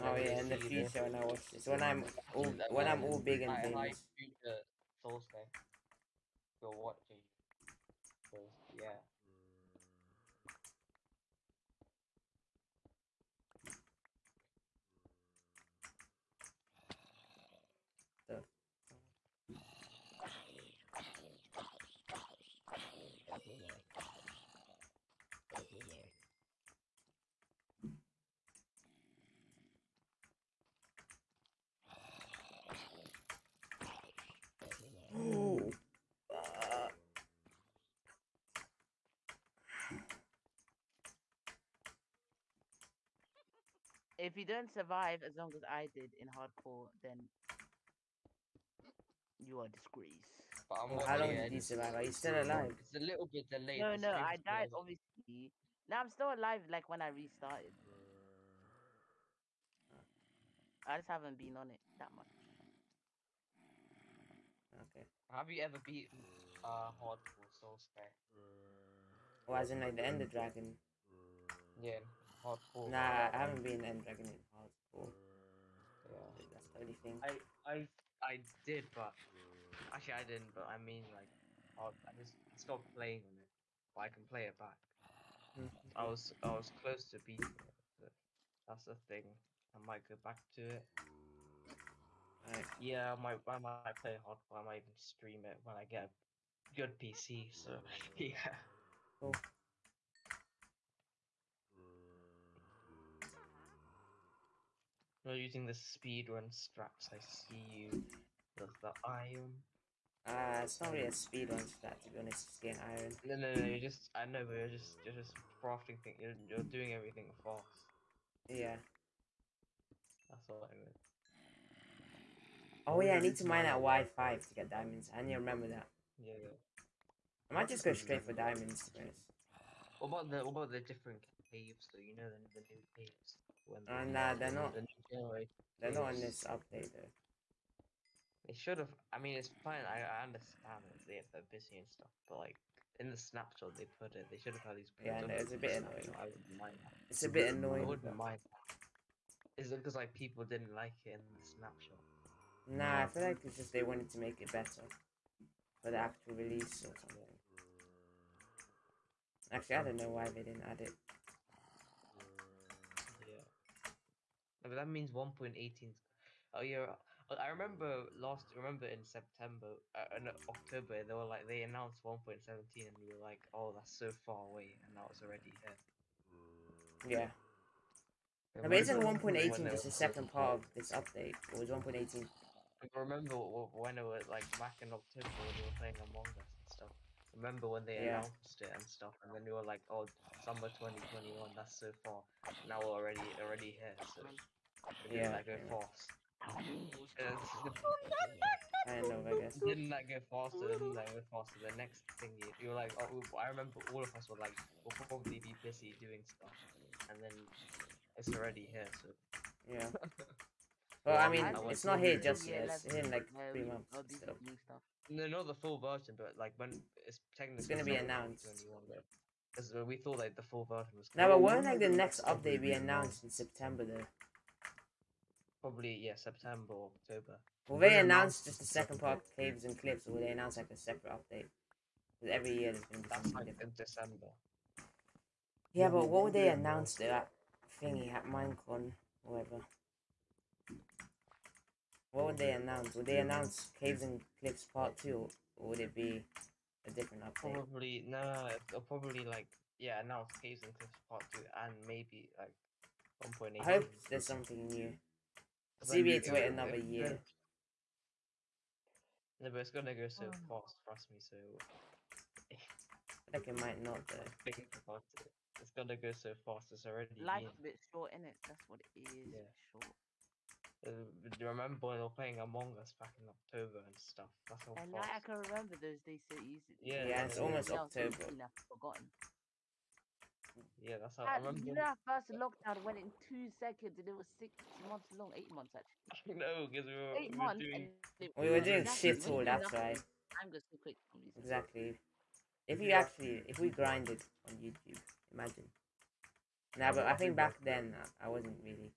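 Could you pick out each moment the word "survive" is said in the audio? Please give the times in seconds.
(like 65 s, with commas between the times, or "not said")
44 s, 51 s.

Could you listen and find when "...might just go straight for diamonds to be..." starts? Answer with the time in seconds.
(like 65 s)
127 s.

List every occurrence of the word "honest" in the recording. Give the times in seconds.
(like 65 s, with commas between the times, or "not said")
112 s, 129 s.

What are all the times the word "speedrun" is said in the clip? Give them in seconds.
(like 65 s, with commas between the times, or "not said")
105 s, 111 s.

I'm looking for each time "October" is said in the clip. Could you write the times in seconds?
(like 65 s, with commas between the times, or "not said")
170 s, 184 s, 227 s, 273 s, 277 s.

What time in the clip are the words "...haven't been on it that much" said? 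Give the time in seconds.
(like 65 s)
61 s.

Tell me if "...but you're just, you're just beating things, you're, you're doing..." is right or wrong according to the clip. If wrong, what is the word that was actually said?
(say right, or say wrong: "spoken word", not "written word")
wrong: "crafting", not "beating".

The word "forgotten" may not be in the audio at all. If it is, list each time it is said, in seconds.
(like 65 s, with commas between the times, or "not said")
278 s.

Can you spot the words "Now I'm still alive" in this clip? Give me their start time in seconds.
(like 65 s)
55 s.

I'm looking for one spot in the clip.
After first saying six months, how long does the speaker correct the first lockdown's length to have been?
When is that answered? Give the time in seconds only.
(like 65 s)
285 s.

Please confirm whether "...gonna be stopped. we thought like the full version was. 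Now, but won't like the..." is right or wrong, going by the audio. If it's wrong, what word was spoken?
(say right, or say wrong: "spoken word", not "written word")
wrong: "announced", not "stopped".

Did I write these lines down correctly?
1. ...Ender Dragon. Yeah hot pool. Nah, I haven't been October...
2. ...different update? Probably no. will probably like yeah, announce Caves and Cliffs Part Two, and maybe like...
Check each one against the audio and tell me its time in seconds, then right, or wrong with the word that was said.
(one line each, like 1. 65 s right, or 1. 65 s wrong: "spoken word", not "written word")
1. 70 s wrong: "Dragon", not "October"
2. 246 s right.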